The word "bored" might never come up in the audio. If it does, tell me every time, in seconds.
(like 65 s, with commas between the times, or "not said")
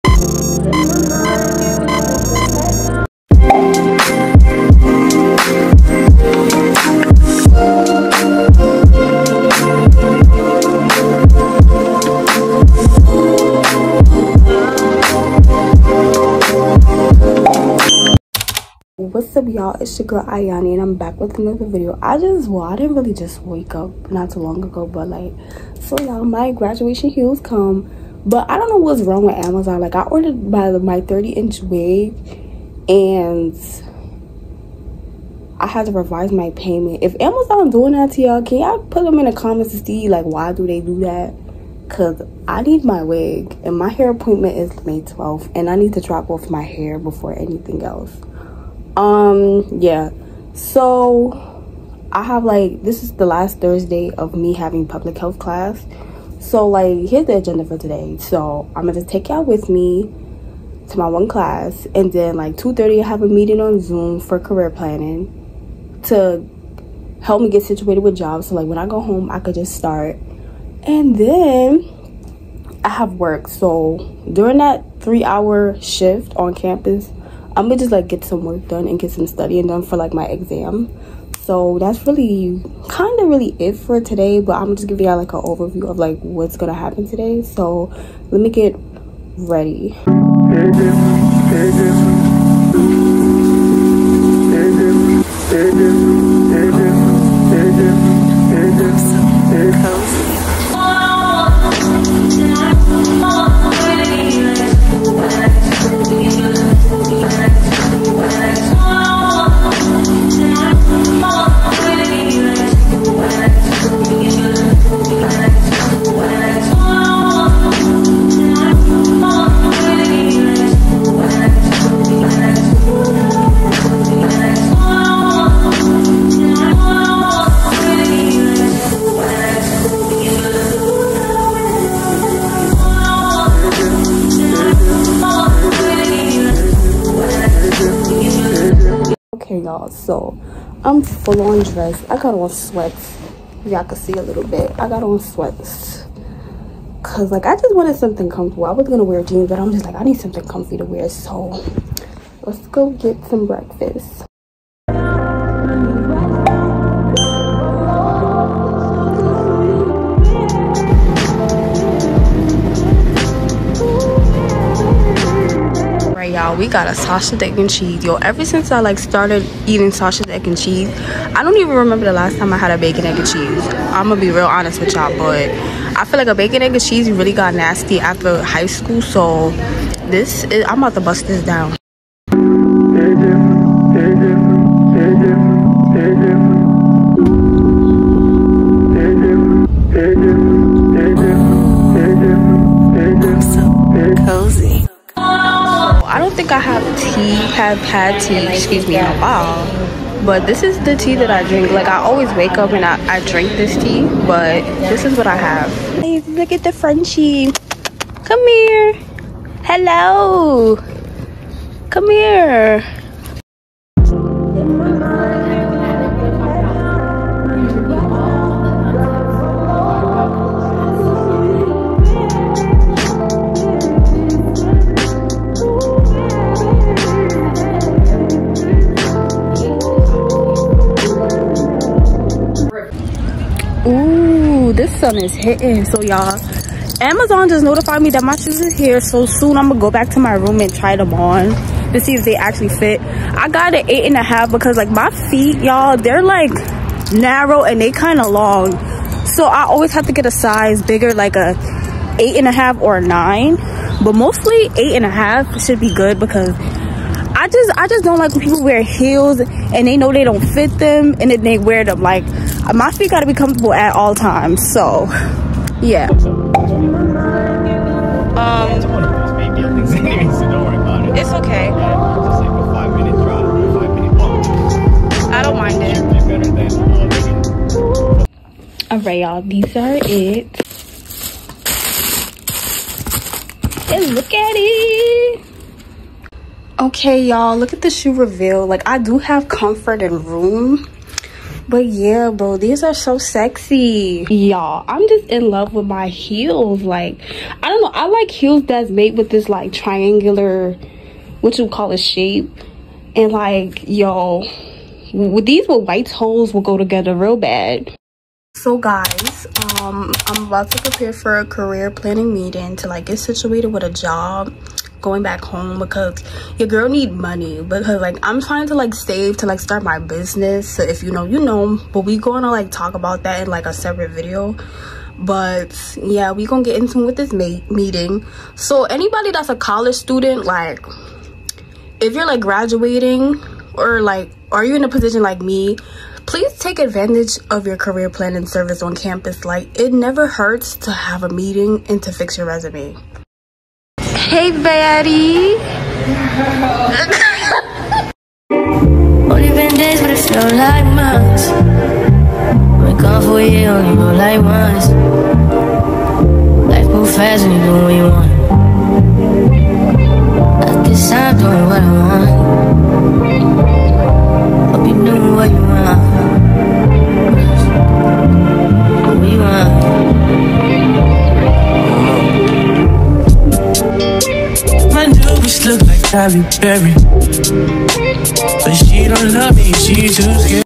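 not said.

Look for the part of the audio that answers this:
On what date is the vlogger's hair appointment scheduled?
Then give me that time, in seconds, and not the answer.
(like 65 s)
44 s.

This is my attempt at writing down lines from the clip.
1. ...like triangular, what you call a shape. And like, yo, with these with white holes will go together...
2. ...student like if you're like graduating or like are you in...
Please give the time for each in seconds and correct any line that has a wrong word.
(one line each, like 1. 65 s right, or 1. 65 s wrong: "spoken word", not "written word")
1. 299 s right
2. 329 s right.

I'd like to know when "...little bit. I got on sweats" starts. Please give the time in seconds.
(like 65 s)
144 s.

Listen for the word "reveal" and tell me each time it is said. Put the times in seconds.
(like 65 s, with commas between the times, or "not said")
288 s.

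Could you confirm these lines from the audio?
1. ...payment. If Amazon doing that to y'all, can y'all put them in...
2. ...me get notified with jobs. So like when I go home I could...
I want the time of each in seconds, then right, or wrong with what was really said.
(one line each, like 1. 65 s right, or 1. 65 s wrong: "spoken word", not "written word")
1. 36 s right
2. 67 s wrong: "situated", not "notified".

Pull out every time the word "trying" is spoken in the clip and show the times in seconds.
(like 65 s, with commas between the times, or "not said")
318 s.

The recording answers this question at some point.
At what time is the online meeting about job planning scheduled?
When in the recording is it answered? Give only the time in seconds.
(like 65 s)
62 s.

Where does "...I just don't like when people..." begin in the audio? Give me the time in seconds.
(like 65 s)
257 s.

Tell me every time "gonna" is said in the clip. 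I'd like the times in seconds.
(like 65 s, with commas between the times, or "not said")
58 s, 77 s, 86 s, 148 s, 174 s, 239 s, 322 s, 326 s.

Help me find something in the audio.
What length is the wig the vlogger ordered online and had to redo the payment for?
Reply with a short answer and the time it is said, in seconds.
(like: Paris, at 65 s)
30 inch, at 31 s.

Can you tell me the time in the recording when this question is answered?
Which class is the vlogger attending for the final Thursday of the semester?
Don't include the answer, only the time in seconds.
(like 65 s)
54 s.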